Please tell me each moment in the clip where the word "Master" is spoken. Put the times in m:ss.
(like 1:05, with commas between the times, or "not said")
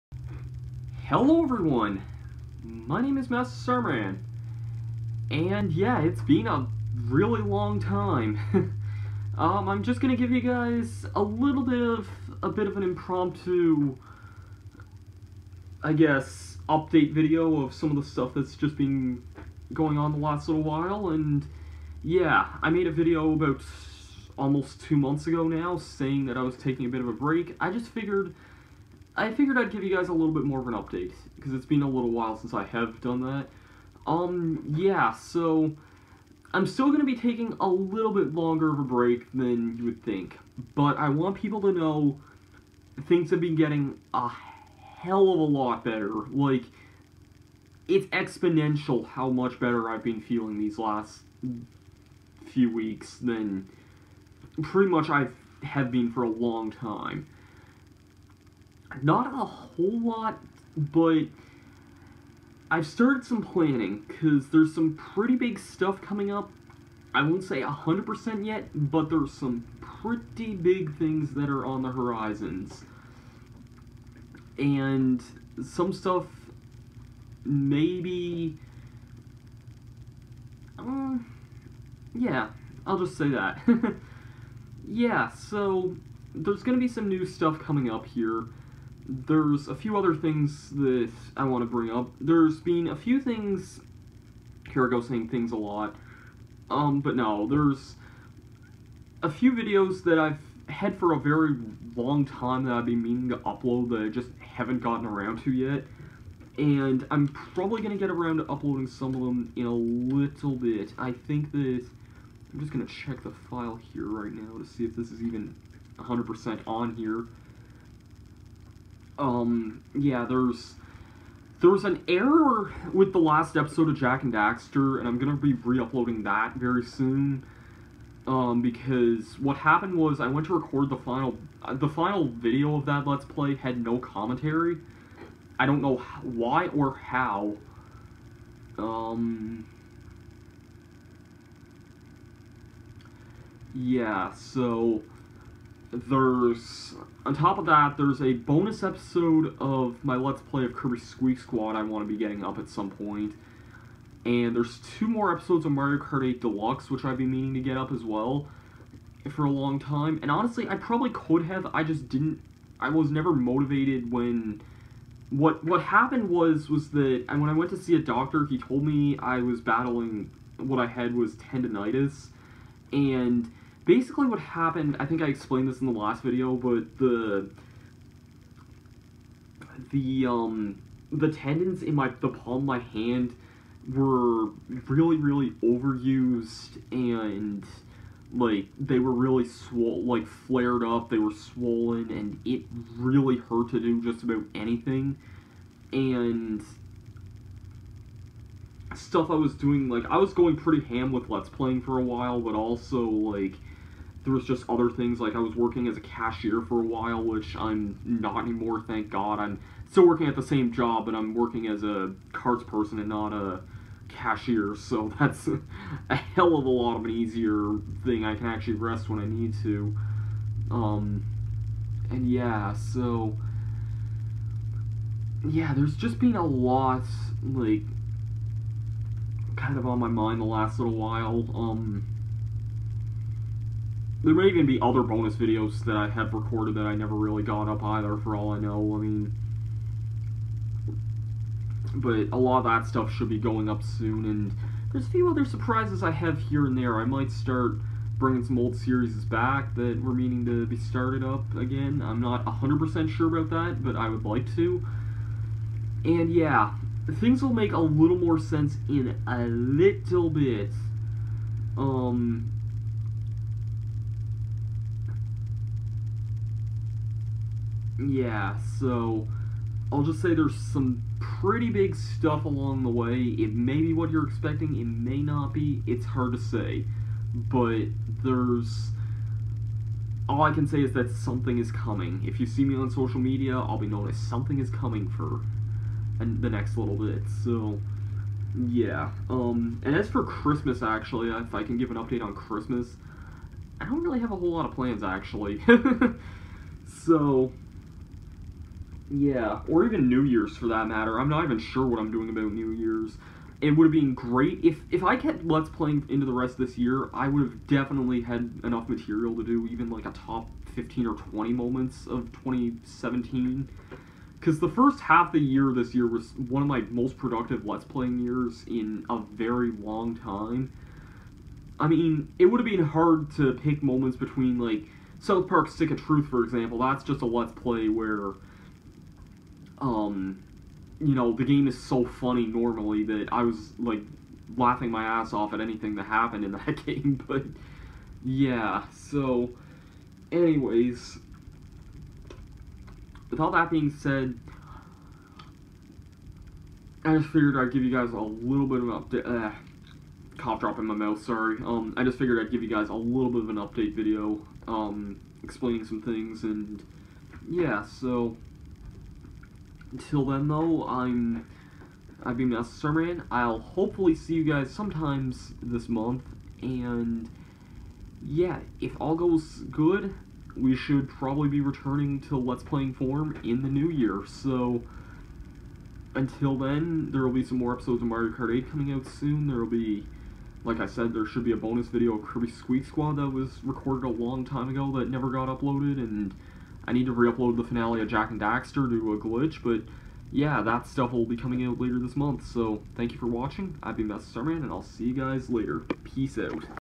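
0:03, 6:02, 6:34.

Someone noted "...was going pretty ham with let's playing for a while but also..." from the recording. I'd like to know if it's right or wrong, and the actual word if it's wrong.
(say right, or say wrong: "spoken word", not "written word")
right.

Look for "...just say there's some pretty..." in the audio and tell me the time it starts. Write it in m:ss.
4:30.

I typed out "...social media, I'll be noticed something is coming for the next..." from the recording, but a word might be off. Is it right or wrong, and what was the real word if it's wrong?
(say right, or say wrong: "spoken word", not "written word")
right.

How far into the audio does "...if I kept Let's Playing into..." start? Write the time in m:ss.
5:04.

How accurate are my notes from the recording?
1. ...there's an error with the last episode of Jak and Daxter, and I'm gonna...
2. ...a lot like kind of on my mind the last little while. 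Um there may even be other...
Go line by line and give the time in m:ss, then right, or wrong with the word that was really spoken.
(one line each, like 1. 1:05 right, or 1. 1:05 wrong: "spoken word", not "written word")
1. 2:01 right
2. 3:46 right.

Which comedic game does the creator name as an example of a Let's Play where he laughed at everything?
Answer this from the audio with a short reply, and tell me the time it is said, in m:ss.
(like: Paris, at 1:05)
South Park Stick of Truth, at 5:25.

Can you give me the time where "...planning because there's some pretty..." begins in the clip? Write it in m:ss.
1:03.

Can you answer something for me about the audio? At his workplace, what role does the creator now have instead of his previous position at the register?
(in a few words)
cards person.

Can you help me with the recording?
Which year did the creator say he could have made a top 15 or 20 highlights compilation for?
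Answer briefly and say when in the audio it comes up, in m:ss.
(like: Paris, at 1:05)
2017, at 5:12.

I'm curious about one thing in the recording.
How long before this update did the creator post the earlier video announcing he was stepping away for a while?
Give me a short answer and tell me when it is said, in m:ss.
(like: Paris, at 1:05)
almost two months, at 0:24.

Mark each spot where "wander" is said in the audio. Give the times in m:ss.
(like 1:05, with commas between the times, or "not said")
not said.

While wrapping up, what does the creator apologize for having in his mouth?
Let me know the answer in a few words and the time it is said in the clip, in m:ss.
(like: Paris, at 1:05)
cough drop, at 5:50.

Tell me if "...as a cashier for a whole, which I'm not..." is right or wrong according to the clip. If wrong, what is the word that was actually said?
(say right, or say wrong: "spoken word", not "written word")
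wrong: "while", not "whole".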